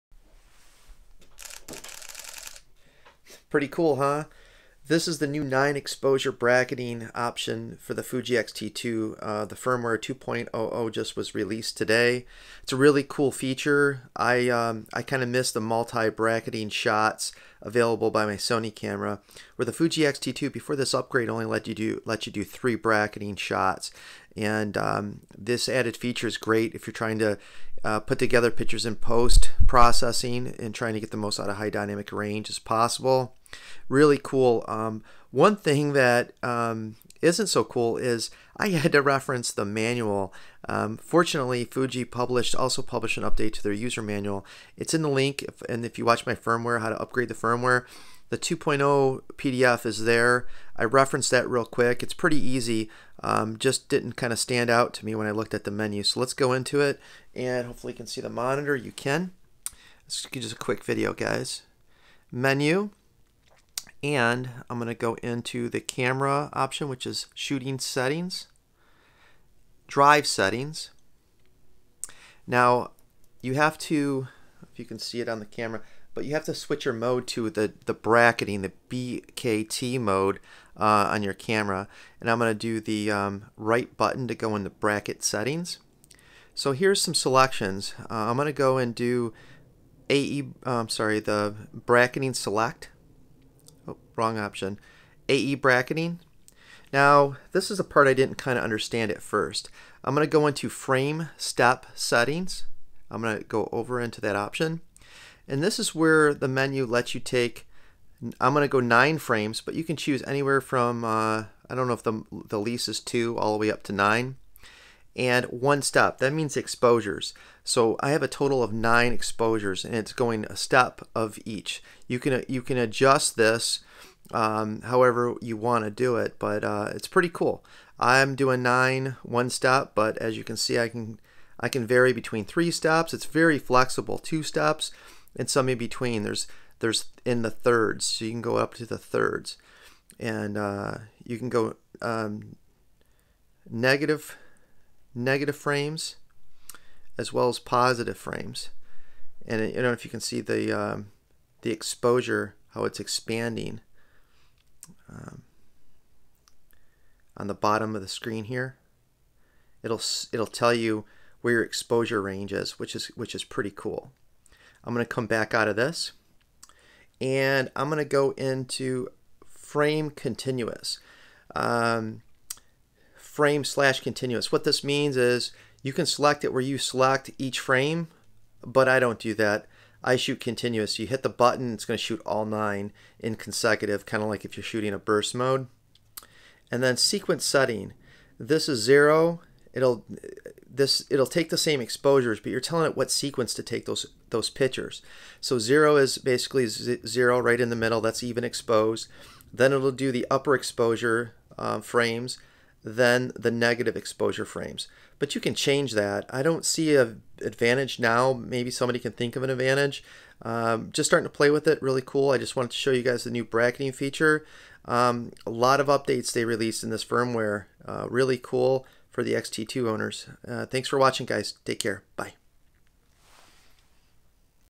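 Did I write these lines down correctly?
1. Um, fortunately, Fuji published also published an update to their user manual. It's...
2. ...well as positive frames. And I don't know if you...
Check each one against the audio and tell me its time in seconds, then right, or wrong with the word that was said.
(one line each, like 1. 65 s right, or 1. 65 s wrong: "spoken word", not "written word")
1. 40 s right
2. 147 s right.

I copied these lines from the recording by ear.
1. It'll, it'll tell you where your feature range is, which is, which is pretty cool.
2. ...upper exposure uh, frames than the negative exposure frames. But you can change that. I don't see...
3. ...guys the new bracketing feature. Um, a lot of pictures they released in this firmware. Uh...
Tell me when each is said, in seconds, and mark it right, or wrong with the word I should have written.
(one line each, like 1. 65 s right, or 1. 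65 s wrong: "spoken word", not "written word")
1. 159 s wrong: "exposure", not "feature"
2. 200 s right
3. 213 s wrong: "updates", not "pictures".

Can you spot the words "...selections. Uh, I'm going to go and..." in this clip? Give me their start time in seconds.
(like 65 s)
87 s.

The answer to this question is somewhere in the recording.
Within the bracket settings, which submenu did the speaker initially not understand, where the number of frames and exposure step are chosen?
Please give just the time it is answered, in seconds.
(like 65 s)
100 s.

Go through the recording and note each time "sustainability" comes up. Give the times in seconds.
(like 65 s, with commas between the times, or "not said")
not said.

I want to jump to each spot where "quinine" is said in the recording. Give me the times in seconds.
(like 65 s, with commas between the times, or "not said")
not said.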